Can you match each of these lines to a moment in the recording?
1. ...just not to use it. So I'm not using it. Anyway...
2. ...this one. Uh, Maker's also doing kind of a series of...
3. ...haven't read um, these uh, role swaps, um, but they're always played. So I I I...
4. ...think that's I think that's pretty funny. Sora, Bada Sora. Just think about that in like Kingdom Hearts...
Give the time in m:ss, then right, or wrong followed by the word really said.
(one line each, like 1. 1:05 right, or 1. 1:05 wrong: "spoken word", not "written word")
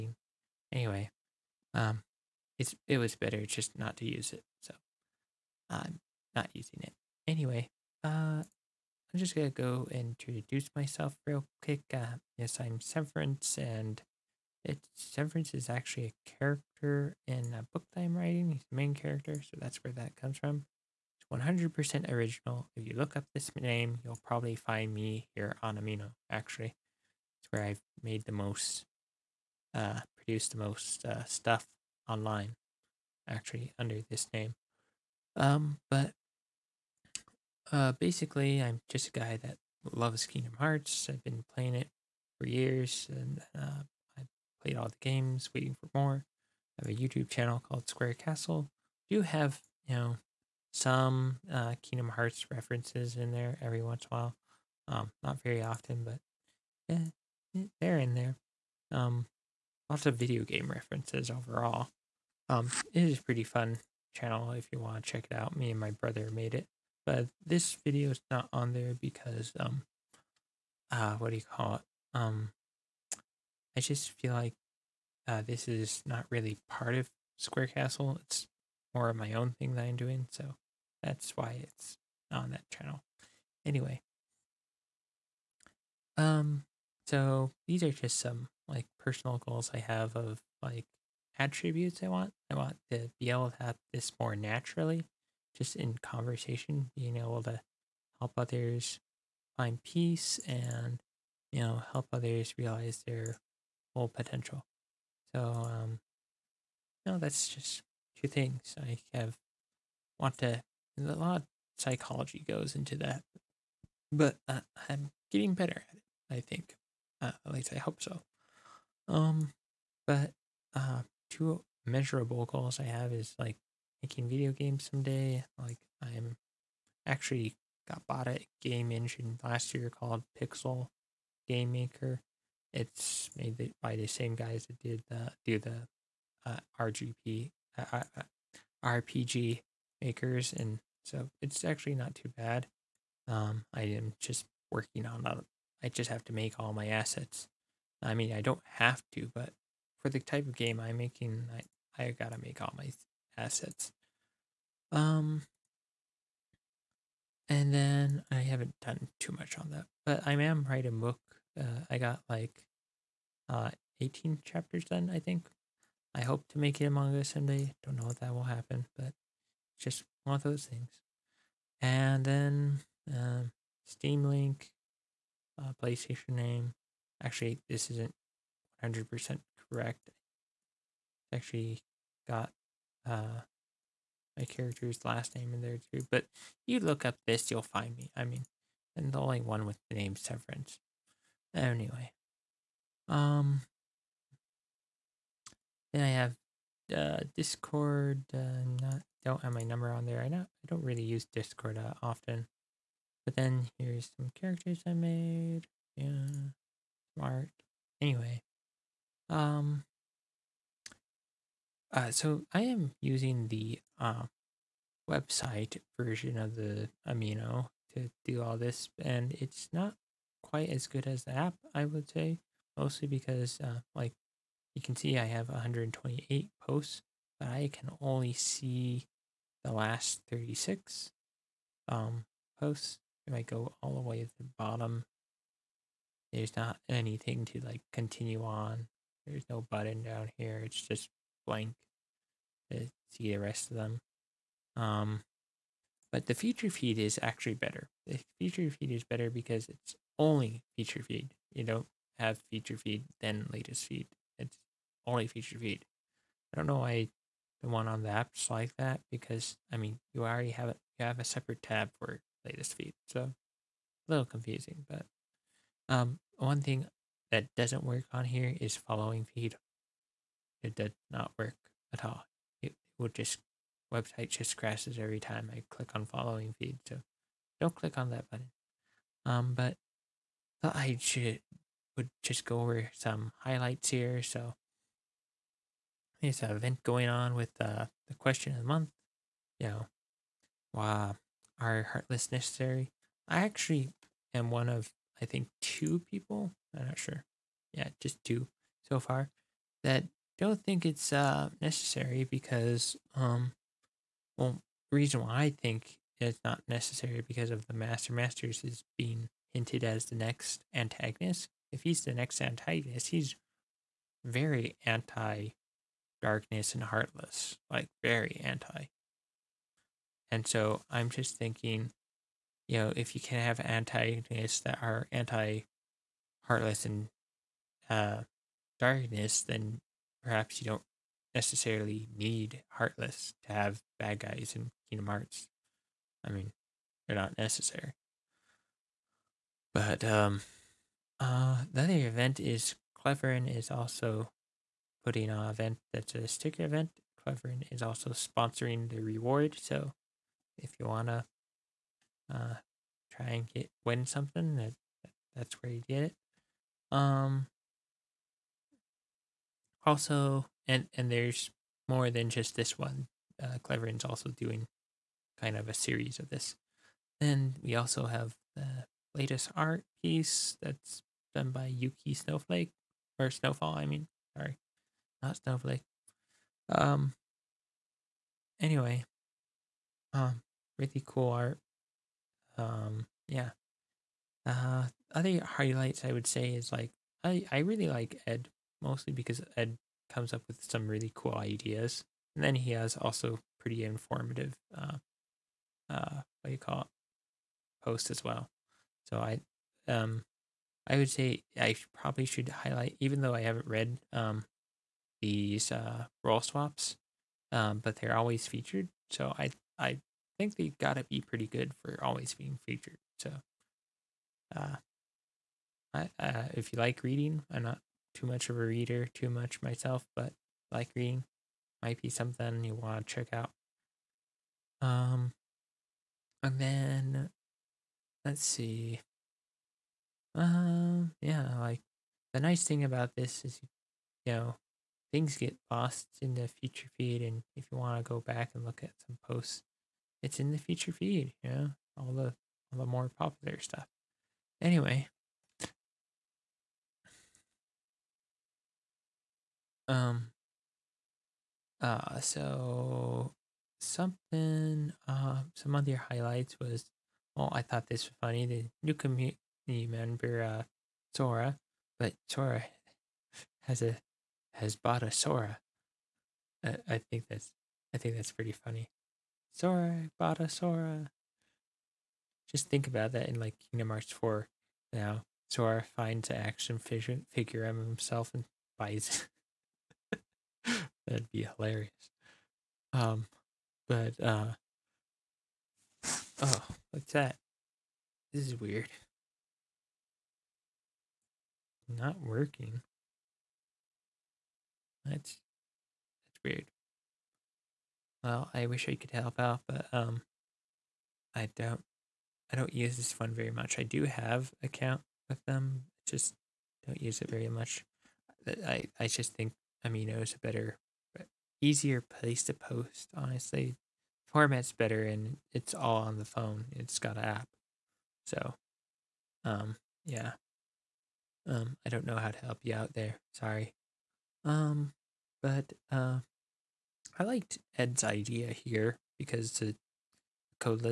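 1. 0:03 right
2. 6:02 wrong: "Cleverin", not "Maker"
3. 6:43 wrong: "featured", not "played"
4. 7:47 right.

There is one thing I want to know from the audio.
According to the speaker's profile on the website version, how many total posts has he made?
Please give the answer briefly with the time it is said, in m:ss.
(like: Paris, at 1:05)
128, at 3:45.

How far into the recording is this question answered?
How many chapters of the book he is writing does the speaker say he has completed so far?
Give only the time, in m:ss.
2:44.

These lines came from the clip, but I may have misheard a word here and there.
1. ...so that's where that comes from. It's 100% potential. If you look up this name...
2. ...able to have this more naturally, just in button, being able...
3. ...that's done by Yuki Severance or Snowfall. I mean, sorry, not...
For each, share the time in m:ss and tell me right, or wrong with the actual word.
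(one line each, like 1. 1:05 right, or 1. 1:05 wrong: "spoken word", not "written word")
1. 0:19 wrong: "original", not "potential"
2. 1:33 wrong: "conversation", not "button"
3. 6:10 wrong: "Snowflake", not "Severance".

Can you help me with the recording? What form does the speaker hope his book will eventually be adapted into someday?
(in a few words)
manga.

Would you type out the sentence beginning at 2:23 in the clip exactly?
Um, I am just working on I just have to make all my assets.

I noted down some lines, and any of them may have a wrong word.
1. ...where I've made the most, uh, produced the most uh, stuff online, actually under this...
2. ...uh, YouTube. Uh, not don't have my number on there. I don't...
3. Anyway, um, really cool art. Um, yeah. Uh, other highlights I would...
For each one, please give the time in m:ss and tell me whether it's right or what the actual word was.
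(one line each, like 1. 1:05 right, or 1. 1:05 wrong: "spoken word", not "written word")
1. 0:27 right
2. 3:16 wrong: "Discord", not "YouTube"
3. 6:18 right.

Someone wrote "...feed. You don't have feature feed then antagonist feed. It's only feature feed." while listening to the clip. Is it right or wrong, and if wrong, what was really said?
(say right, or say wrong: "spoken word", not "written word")
wrong: "latest", not "antagonist".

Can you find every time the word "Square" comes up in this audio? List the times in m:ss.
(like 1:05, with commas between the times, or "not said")
0:47, 1:17.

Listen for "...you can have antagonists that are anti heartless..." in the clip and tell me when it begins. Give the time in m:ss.
5:23.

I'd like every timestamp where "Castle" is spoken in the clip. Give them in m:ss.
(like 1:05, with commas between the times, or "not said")
0:48, 1:17.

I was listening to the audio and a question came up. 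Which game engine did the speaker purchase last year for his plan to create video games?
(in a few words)
Pixel Game Maker.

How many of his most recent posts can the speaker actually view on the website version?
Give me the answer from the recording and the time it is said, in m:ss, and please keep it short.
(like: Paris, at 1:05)
36, at 3:50.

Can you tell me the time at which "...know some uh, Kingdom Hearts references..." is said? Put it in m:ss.
0:49.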